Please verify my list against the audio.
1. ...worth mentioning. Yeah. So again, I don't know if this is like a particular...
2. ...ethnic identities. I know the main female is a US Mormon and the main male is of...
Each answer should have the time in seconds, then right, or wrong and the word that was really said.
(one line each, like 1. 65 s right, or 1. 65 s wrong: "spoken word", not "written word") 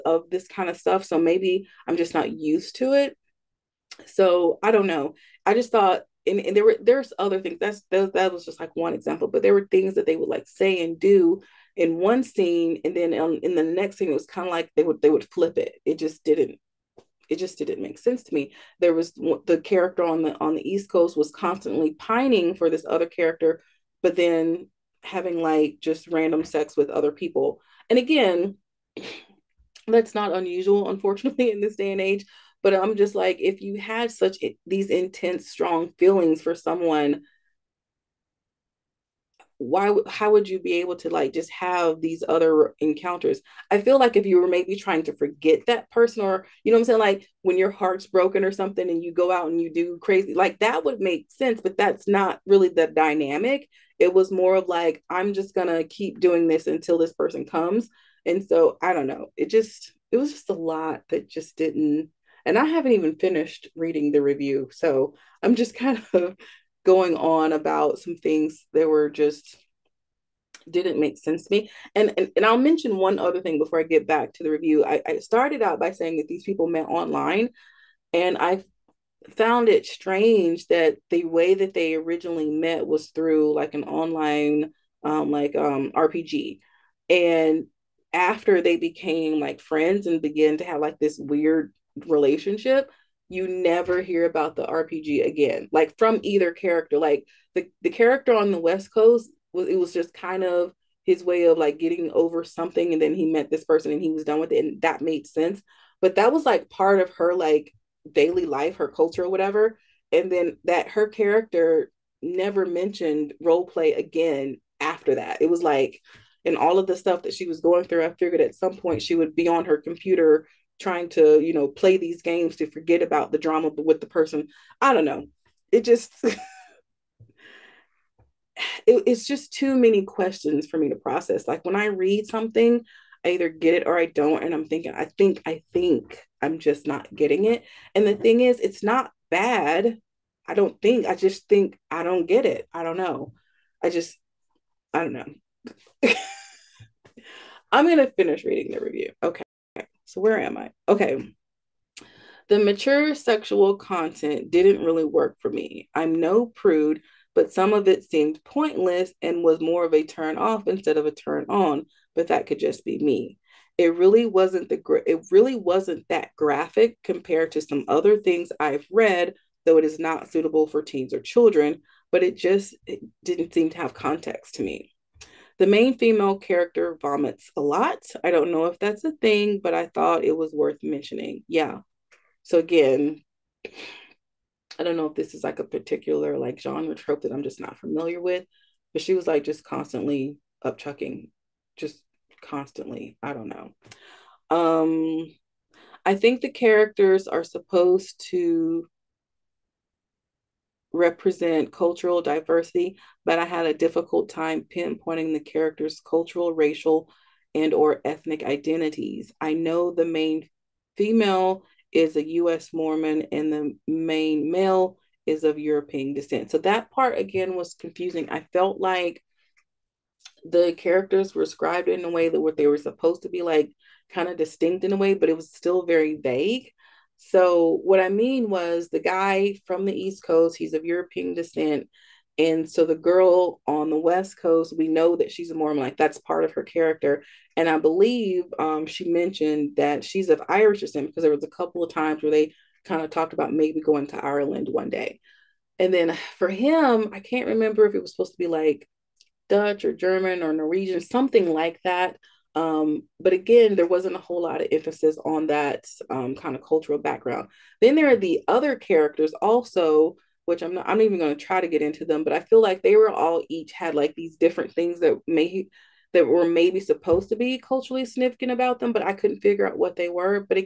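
1. 180 s right
2. 208 s right.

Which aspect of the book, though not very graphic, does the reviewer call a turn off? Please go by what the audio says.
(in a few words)
Mature sexual content.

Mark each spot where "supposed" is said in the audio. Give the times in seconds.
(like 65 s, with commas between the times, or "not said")
197 s, 222 s, 248 s, 266 s.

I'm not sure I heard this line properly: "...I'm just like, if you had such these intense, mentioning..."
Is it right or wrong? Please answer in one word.
wrong.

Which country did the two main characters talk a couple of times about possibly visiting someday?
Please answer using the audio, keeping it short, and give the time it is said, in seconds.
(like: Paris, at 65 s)
Ireland, at 244 s.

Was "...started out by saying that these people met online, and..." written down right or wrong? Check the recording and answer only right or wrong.
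right.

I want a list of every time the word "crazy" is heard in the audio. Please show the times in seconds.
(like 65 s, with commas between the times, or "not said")
50 s.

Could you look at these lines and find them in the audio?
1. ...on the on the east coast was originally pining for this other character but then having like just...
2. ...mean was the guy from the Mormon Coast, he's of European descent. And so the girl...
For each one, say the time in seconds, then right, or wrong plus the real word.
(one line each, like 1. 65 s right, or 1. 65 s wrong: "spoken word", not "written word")
1. 20 s wrong: "constantly", not "originally"
2. 228 s wrong: "East", not "Mormon".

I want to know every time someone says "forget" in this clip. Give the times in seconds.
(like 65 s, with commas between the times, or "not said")
45 s, 122 s.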